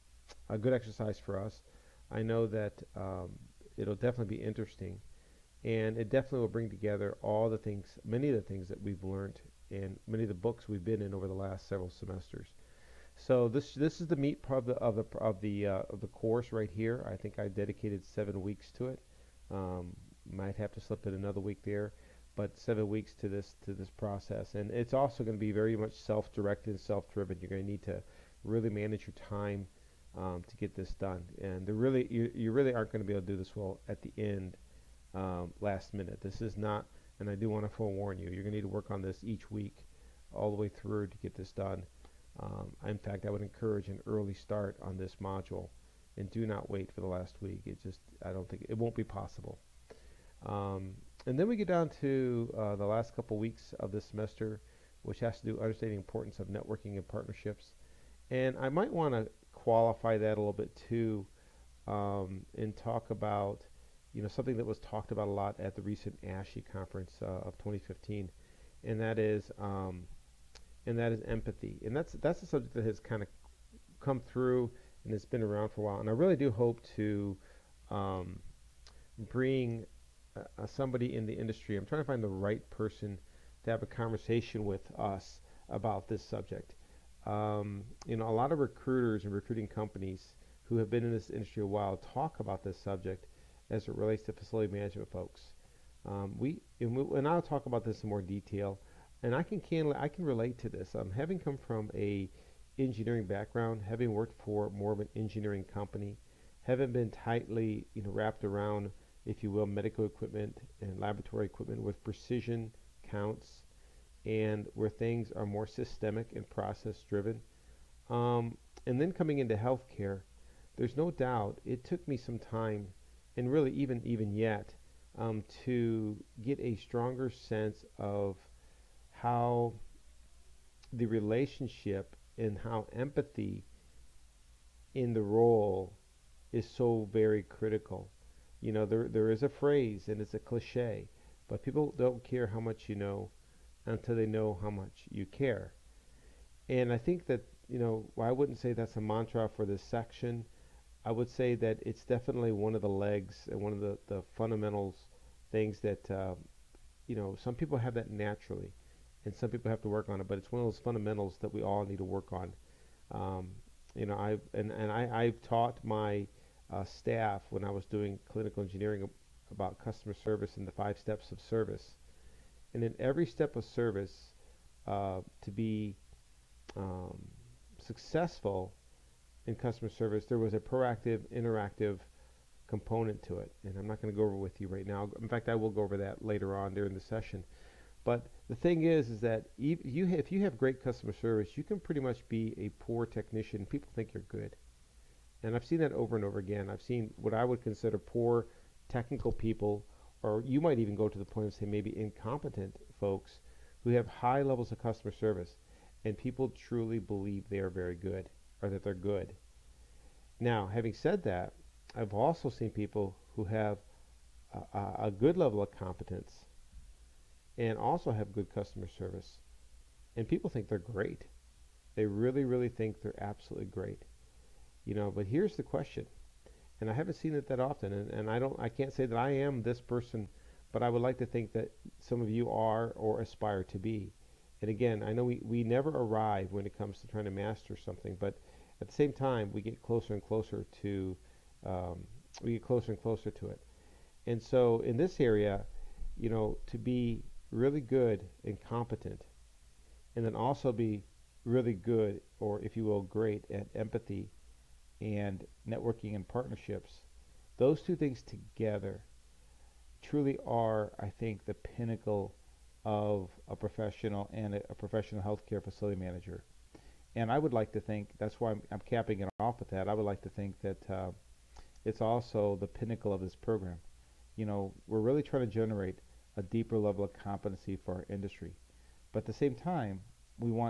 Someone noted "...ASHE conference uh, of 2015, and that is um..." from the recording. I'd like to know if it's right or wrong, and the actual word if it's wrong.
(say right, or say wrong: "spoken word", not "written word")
right.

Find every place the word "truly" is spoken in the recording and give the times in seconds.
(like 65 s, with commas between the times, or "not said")
206 s, 260 s.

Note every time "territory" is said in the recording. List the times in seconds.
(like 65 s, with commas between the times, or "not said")
not said.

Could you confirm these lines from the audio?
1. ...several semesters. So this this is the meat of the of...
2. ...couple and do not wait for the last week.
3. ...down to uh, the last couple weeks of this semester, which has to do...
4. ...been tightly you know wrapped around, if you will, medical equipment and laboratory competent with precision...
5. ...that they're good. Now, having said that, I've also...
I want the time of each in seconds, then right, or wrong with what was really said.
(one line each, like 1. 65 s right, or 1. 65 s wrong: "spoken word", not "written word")
1. 11 s right
2. 45 s wrong: "module", not "couple"
3. 51 s right
4. 106 s wrong: "equipment", not "competent"
5. 208 s right.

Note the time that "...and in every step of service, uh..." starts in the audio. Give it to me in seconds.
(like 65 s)
172 s.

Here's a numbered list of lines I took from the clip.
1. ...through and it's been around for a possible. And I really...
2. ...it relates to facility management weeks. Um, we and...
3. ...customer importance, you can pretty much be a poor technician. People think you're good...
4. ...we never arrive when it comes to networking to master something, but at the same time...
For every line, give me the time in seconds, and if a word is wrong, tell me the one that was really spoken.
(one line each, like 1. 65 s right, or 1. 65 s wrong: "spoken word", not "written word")
1. 74 s wrong: "while", not "possible"
2. 93 s wrong: "folks", not "weeks"
3. 190 s wrong: "service", not "importance"
4. 235 s wrong: "trying", not "networking".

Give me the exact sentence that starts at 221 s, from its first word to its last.
They really, really think they're absolutely great.